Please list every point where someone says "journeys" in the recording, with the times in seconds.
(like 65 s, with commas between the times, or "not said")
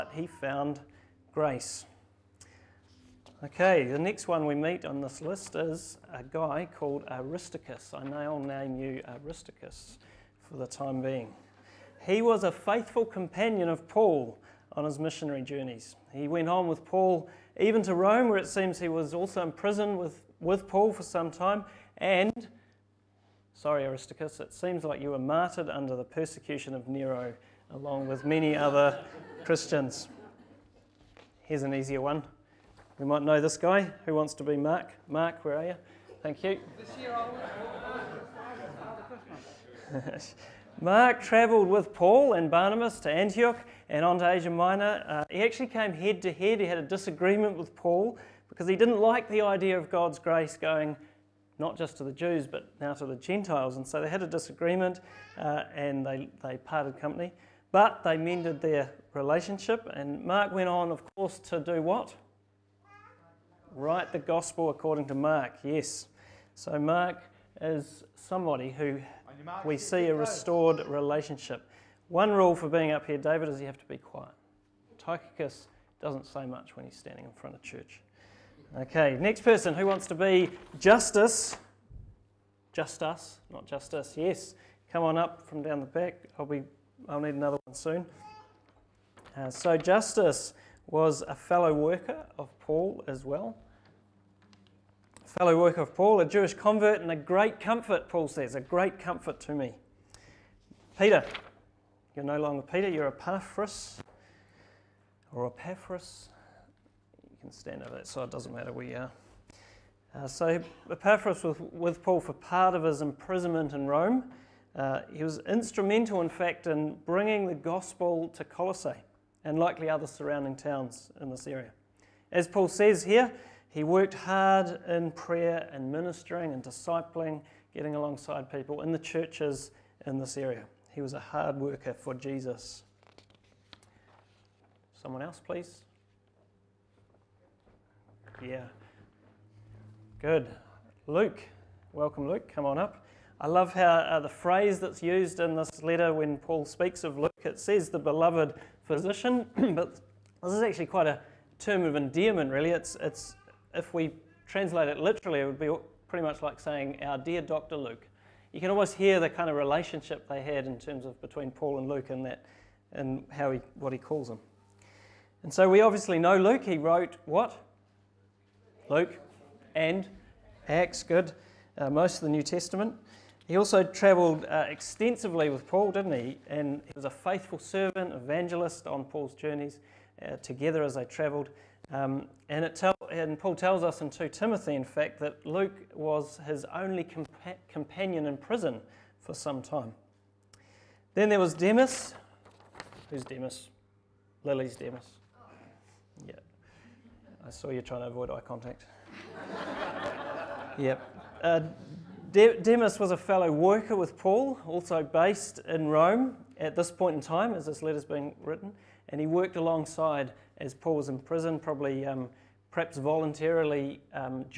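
15 s, 179 s.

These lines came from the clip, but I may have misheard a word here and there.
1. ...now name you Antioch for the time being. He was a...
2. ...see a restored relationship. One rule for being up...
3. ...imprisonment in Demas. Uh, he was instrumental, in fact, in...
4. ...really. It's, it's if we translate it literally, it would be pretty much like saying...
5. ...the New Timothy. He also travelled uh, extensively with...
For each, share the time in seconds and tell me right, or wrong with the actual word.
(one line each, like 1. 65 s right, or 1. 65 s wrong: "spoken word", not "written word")
1. 8 s wrong: "Aristarchus", not "Antioch"
2. 69 s right
3. 113 s wrong: "Rome", not "Demas"
4. 152 s right
5. 172 s wrong: "Testament", not "Timothy".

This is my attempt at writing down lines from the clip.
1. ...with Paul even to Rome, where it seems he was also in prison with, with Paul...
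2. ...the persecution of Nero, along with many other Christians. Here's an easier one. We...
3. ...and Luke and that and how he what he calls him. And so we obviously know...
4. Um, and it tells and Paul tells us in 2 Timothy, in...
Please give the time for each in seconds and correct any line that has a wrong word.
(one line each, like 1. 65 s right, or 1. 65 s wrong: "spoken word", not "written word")
1. 16 s right
2. 25 s right
3. 161 s right
4. 181 s right.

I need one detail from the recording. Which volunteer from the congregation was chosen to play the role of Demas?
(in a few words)
Lily.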